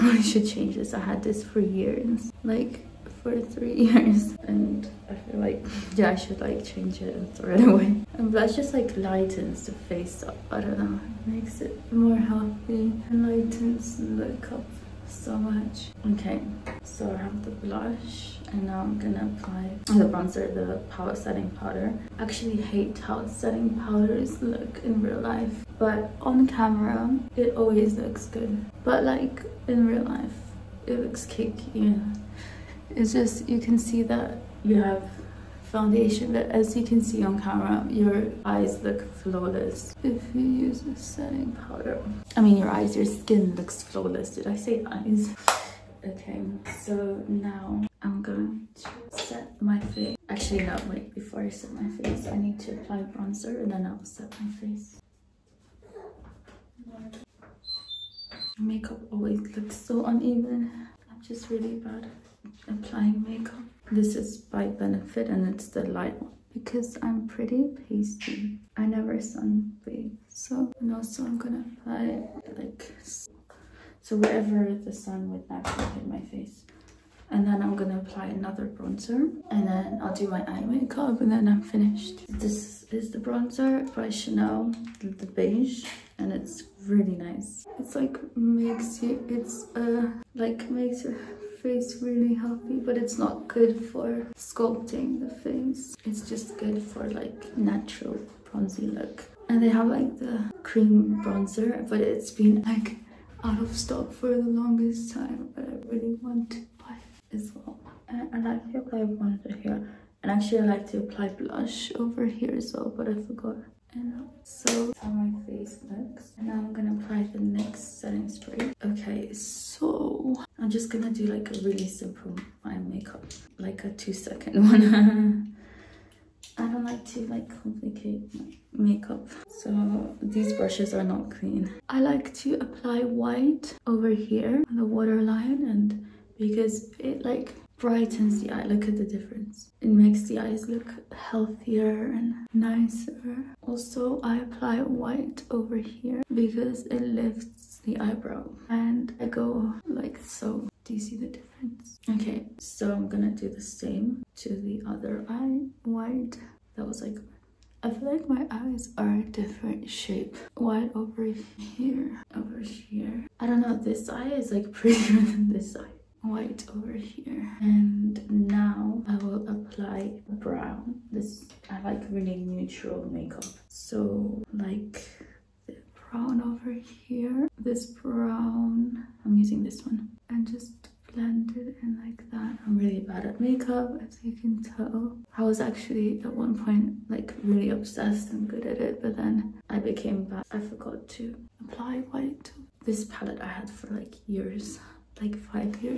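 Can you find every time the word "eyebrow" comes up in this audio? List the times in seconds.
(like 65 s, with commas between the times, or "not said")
147 s.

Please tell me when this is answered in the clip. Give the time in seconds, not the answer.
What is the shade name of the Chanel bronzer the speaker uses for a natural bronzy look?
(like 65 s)
84 s.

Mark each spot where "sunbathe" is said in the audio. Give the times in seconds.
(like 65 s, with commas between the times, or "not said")
69 s.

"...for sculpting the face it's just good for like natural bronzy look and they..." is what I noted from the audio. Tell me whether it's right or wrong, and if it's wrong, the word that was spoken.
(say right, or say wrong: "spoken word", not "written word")
right.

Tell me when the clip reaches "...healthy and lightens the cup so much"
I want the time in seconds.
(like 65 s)
12 s.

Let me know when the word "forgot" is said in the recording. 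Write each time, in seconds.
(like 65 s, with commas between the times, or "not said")
113 s, 190 s.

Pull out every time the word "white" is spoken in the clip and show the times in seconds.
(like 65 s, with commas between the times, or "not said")
133 s, 144 s, 155 s, 160 s, 166 s, 192 s.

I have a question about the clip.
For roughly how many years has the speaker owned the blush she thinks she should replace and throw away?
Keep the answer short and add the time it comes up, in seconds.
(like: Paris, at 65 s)
3, at 3 s.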